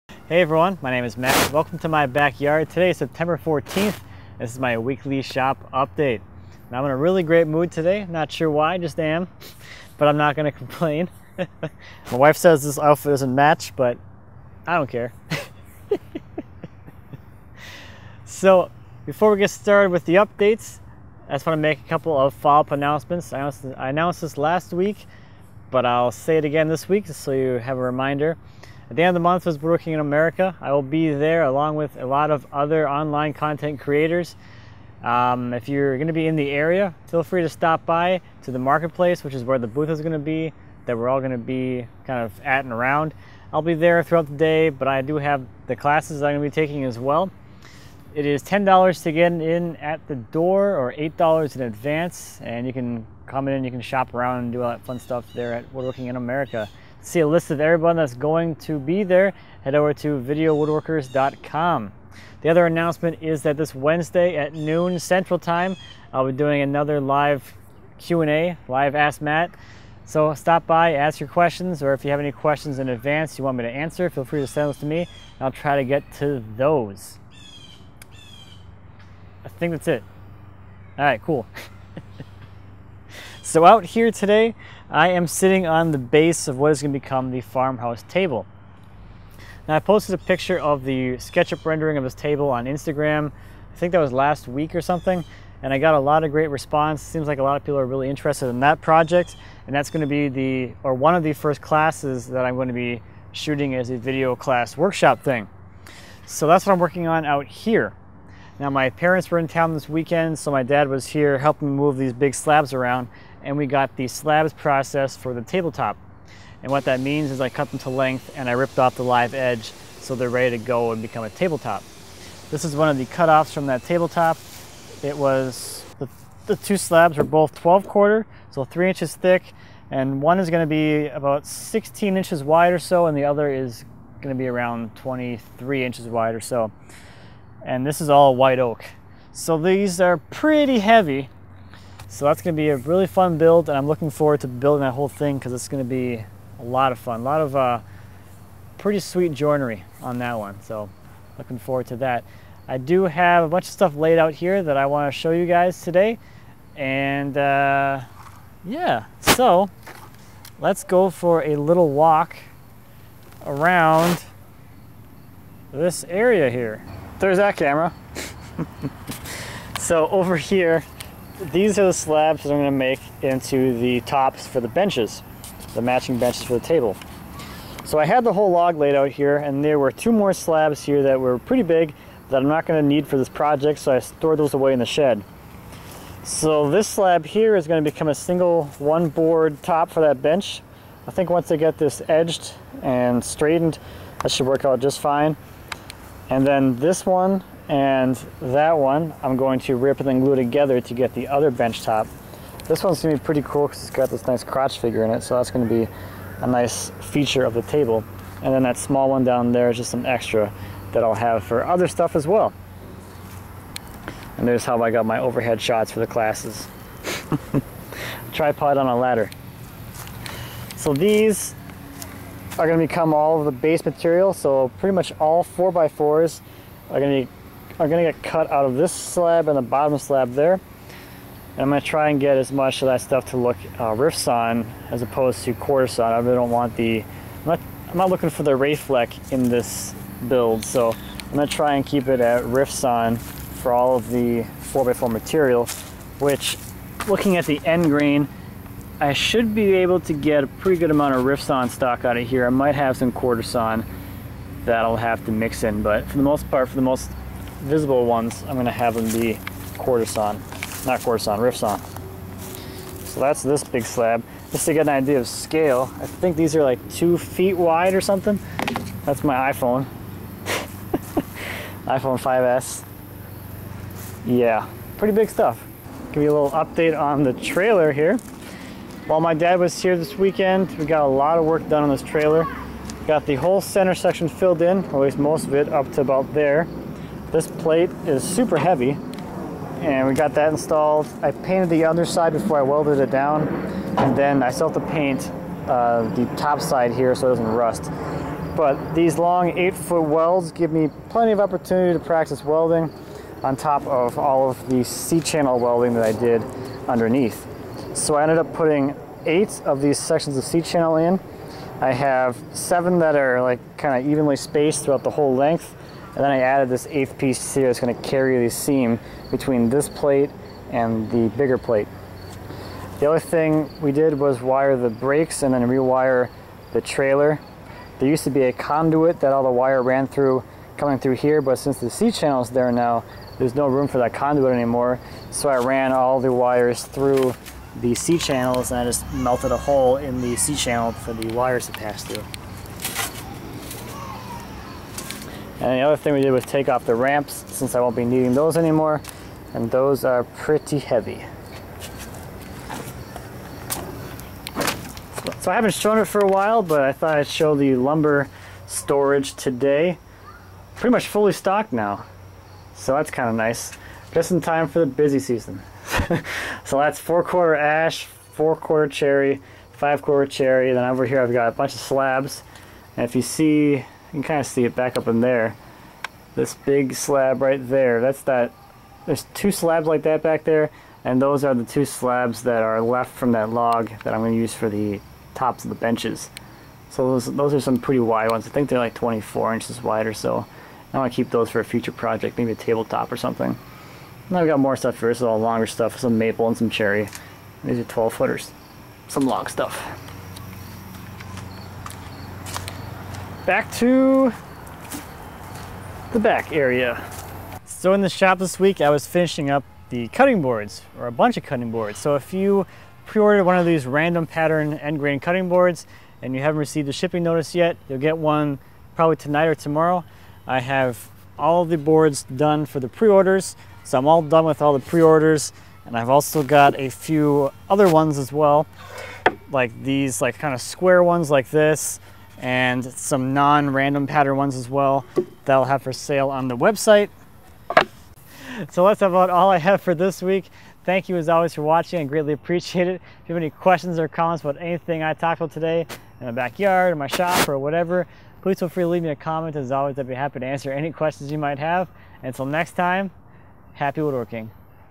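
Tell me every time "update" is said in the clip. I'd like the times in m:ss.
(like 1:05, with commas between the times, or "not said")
0:05, 0:20, 4:36.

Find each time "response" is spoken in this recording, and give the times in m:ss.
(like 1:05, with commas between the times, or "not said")
1:36.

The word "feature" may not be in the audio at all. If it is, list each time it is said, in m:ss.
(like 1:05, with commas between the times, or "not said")
3:26.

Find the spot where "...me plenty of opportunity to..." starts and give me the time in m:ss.
5:00.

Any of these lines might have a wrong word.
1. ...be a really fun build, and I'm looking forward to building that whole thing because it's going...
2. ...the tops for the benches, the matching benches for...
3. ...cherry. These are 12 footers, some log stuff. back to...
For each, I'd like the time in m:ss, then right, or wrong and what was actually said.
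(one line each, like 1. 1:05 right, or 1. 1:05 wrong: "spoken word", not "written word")
1. 2:22 right
2. 2:53 right
3. 6:36 right.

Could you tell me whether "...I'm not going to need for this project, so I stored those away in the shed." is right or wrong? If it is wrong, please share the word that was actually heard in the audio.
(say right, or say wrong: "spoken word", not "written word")
right.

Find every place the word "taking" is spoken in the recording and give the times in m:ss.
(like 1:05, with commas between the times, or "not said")
0:46.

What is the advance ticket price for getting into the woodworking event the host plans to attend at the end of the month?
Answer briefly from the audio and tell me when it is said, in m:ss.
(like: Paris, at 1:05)
$8, at 0:50.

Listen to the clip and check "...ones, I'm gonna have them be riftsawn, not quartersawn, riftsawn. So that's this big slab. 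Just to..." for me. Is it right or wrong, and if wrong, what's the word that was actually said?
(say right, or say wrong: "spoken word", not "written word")
wrong: "quartersawn", not "riftsawn".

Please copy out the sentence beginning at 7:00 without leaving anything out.
I have all the boards done for the pre-orders.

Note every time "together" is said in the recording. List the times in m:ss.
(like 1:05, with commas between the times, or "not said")
3:20.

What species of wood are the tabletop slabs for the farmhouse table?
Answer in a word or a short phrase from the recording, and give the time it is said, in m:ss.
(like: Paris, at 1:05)
White oak, at 2:18.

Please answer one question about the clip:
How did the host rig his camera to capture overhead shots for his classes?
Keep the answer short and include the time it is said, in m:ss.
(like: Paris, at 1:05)
Tripod on a ladder, at 3:38.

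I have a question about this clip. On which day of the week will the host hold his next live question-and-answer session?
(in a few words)
Wednesday.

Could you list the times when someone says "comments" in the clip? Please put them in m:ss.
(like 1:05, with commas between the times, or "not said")
7:24, 7:29.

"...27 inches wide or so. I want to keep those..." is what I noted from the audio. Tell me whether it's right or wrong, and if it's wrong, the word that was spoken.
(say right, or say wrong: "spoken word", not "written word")
wrong: "24", not "27".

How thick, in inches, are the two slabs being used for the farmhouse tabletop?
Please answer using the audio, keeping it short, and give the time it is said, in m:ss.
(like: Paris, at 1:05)
3 inches, at 2:08.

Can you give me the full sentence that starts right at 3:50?
And I'm going to try and get as much of that stuff to look uh, on as opposed to quartersawn.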